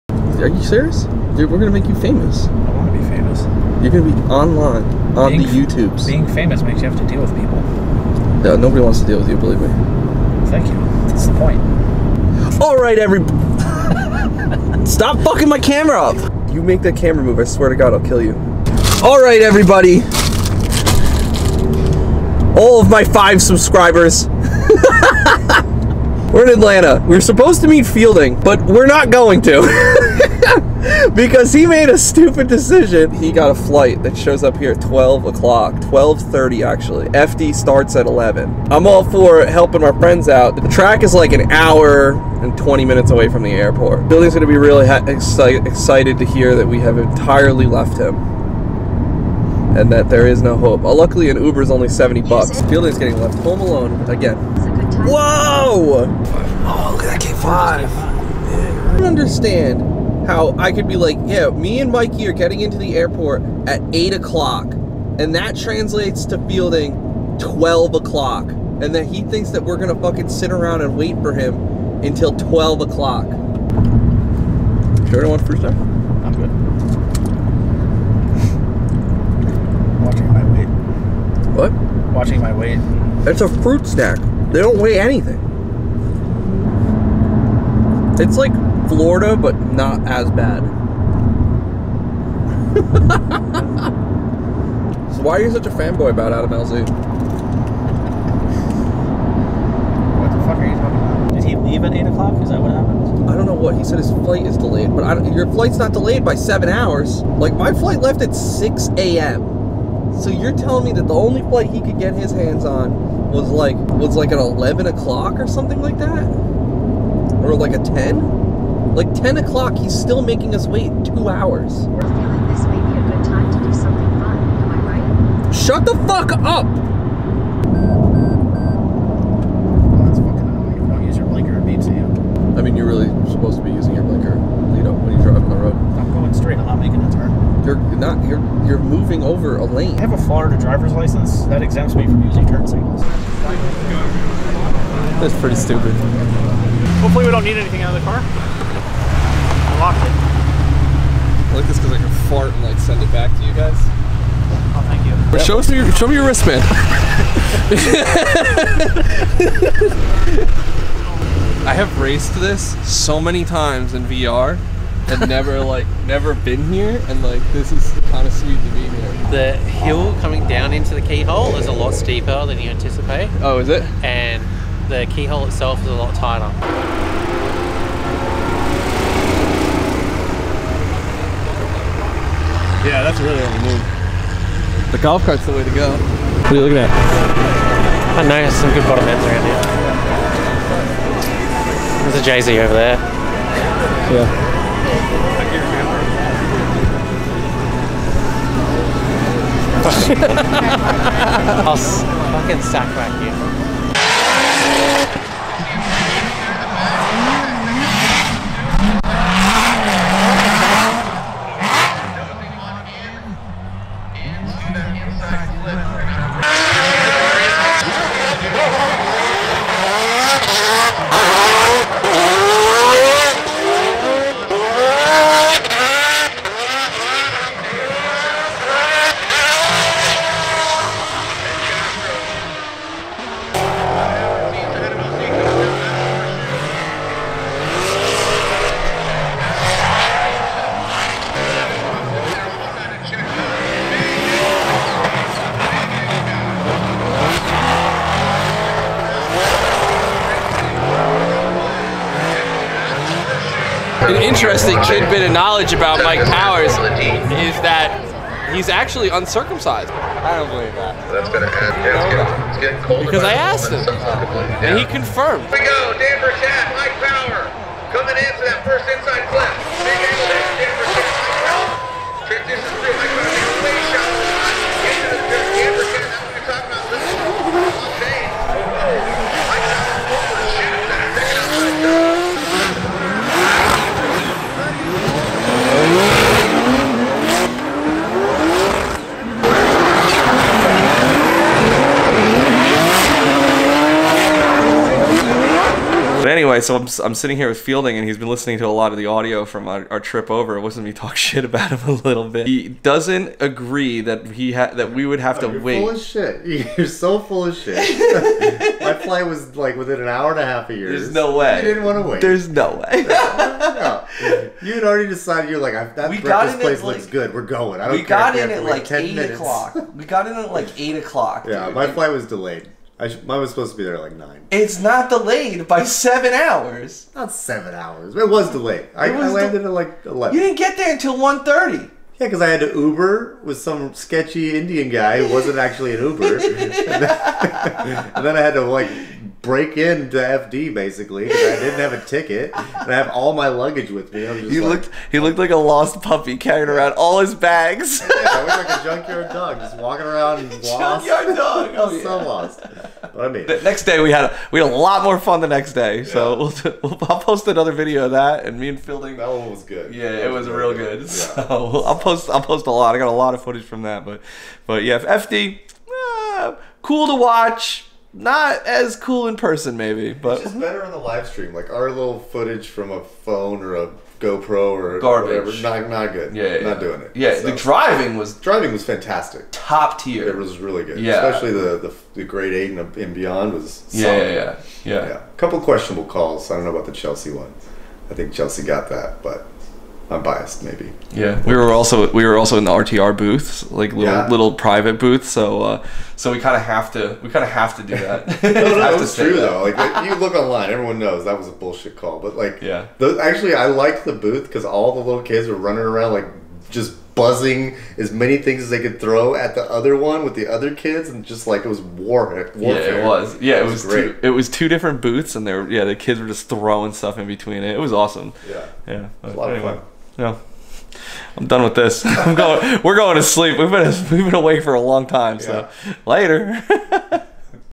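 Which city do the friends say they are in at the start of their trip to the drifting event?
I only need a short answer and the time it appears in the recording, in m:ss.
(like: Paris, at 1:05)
Atlanta, at 0:26.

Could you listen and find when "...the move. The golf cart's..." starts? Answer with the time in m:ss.
3:03.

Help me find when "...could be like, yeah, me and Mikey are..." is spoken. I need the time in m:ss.
1:00.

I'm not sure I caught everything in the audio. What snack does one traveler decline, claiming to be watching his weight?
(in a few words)
Fruit snack.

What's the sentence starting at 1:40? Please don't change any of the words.
What the fuck are you talking about?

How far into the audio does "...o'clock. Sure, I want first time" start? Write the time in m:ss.
1:12.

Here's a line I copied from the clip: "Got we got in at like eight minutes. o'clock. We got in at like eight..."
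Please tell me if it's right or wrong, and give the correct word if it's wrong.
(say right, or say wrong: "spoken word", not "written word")
right.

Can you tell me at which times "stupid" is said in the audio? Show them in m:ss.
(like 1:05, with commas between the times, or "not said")
0:31, 2:25.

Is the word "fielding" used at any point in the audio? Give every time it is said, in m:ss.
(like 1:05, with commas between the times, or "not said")
0:27, 0:44, 0:52, 1:06, 4:57, 5:58.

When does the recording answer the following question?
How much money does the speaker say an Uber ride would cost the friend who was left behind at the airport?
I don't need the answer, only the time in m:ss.
0:51.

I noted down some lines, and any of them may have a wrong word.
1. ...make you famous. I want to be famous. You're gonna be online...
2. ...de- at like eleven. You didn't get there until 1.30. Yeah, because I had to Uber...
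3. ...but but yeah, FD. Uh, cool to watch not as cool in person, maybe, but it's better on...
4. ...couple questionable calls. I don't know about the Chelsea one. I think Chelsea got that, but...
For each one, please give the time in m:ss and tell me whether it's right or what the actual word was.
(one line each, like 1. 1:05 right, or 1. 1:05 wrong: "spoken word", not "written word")
1. 0:01 right
2. 5:29 right
3. 6:04 right
4. 6:25 right.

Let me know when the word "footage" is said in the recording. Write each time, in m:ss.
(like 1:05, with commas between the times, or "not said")
6:03, 6:12.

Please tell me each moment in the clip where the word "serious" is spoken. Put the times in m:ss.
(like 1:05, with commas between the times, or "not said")
0:00.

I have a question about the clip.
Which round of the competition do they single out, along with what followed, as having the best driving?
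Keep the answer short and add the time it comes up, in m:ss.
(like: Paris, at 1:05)
Great Eight, at 6:22.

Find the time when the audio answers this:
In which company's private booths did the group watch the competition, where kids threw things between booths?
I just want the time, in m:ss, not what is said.
6:32.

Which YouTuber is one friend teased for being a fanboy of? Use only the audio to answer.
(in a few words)
Adam LZ.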